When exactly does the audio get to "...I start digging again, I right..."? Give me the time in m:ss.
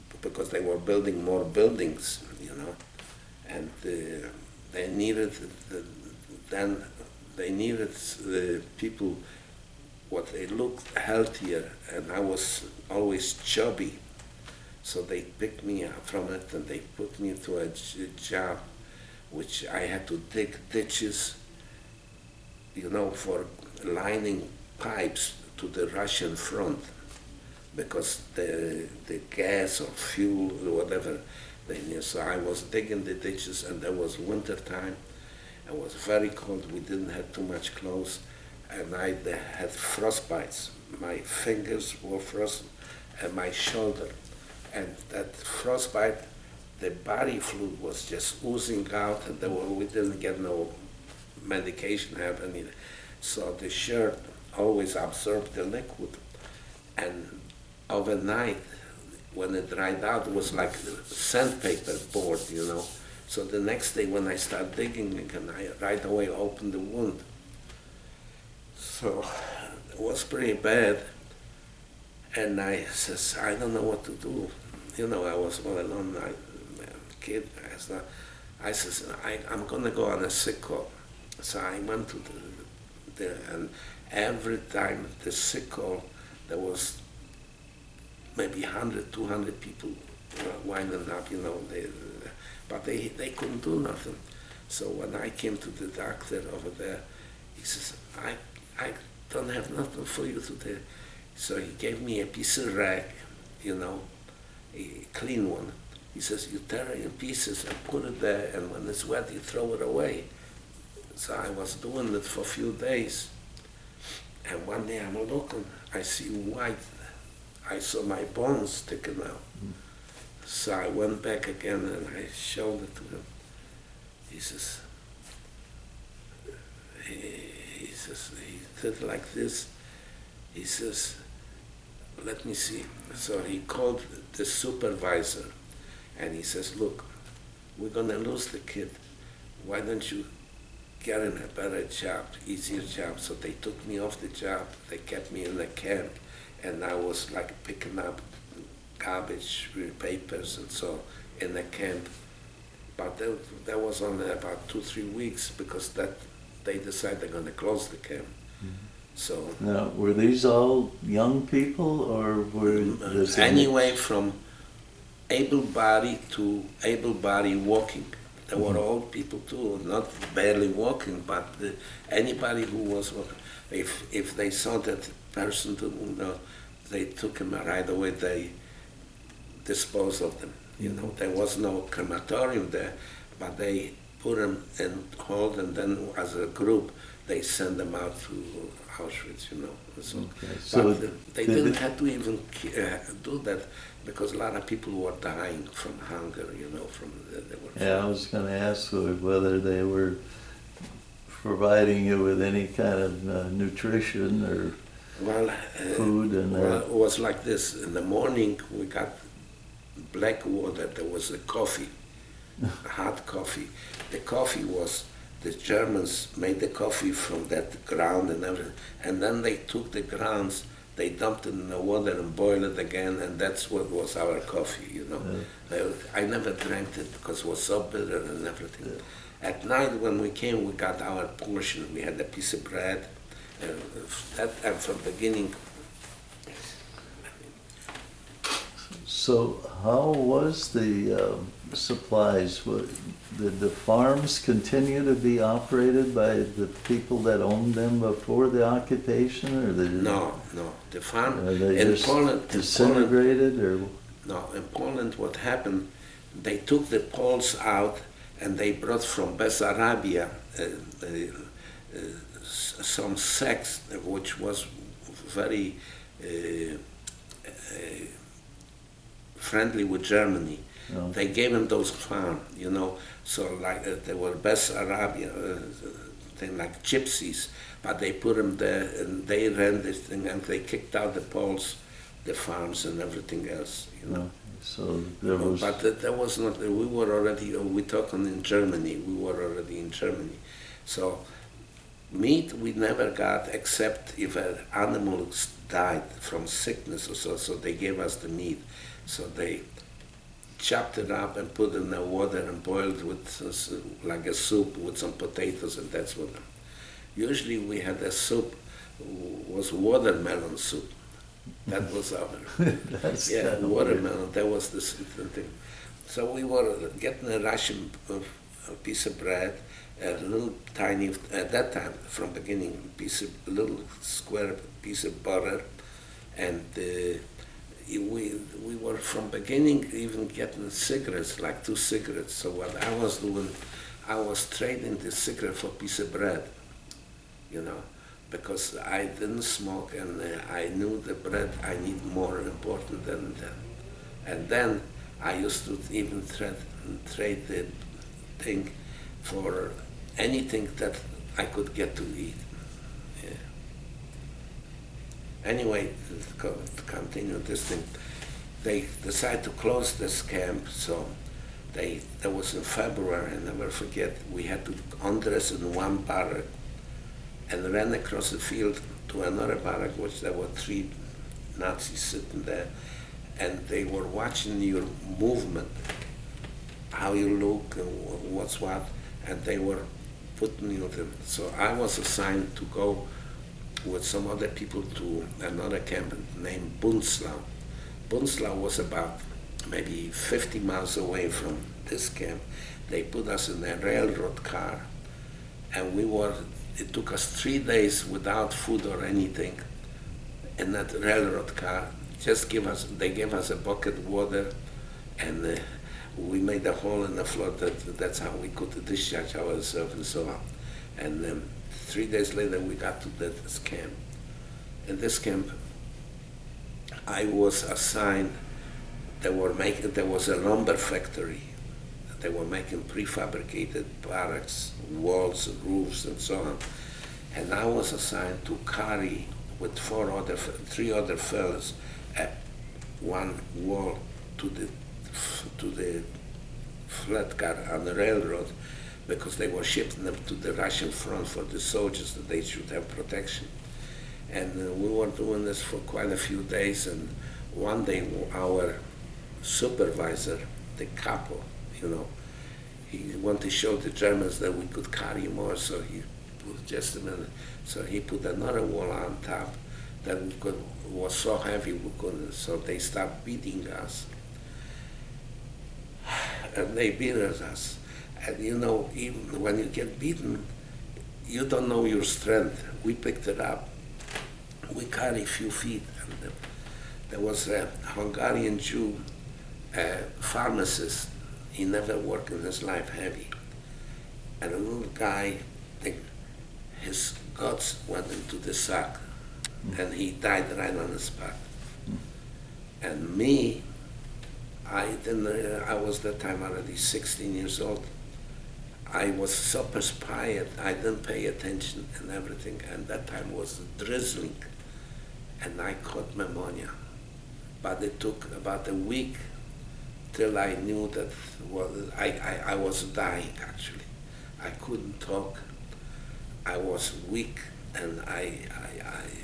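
1:04.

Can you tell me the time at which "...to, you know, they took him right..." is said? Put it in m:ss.
2:55.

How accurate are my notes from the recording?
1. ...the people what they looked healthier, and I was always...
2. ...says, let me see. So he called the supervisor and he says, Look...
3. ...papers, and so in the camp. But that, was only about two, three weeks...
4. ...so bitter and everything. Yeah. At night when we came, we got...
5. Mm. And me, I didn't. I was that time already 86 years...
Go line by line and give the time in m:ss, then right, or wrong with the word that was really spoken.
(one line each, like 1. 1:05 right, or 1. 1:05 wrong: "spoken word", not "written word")
1. 0:07 right
2. 2:10 right
3. 2:29 right
4. 3:47 right
5. 8:11 wrong: "16", not "86".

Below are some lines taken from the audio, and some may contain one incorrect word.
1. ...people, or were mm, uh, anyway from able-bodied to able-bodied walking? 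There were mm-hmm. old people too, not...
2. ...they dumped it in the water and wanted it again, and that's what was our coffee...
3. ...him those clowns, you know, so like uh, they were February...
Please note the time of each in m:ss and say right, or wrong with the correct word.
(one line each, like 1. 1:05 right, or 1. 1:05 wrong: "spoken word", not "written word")
1. 2:41 right
2. 3:40 wrong: "boiled", not "wanted"
3. 4:31 wrong: "Bessarabian", not "February".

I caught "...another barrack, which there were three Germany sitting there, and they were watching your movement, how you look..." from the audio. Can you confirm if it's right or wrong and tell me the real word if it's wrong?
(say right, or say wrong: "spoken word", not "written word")
wrong: "Nazis", not "Germany".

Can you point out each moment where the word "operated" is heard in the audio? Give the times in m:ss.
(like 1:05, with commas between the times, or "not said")
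4:05.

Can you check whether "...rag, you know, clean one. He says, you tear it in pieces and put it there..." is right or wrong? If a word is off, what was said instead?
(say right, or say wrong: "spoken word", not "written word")
right.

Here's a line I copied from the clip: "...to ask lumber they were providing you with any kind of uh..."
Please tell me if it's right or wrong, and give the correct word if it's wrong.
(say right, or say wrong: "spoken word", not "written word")
wrong: "whether", not "lumber".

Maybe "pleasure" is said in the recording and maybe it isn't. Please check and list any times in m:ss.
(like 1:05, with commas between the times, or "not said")
not said.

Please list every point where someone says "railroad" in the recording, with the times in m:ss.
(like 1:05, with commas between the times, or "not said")
6:33, 6:40, 7:17.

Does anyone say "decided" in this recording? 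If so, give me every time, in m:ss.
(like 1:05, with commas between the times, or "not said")
2:36, 5:59.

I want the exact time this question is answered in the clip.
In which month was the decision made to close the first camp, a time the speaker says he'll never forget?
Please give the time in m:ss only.
6:02.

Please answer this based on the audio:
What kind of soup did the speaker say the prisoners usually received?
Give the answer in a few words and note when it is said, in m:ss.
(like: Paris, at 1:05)
watermelon soup, at 5:09.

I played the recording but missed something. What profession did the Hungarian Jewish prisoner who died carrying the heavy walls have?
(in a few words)
pharmacist.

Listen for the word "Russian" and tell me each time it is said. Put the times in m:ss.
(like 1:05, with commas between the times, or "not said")
0:25, 5:17, 7:20.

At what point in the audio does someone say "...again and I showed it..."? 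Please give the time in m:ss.
2:01.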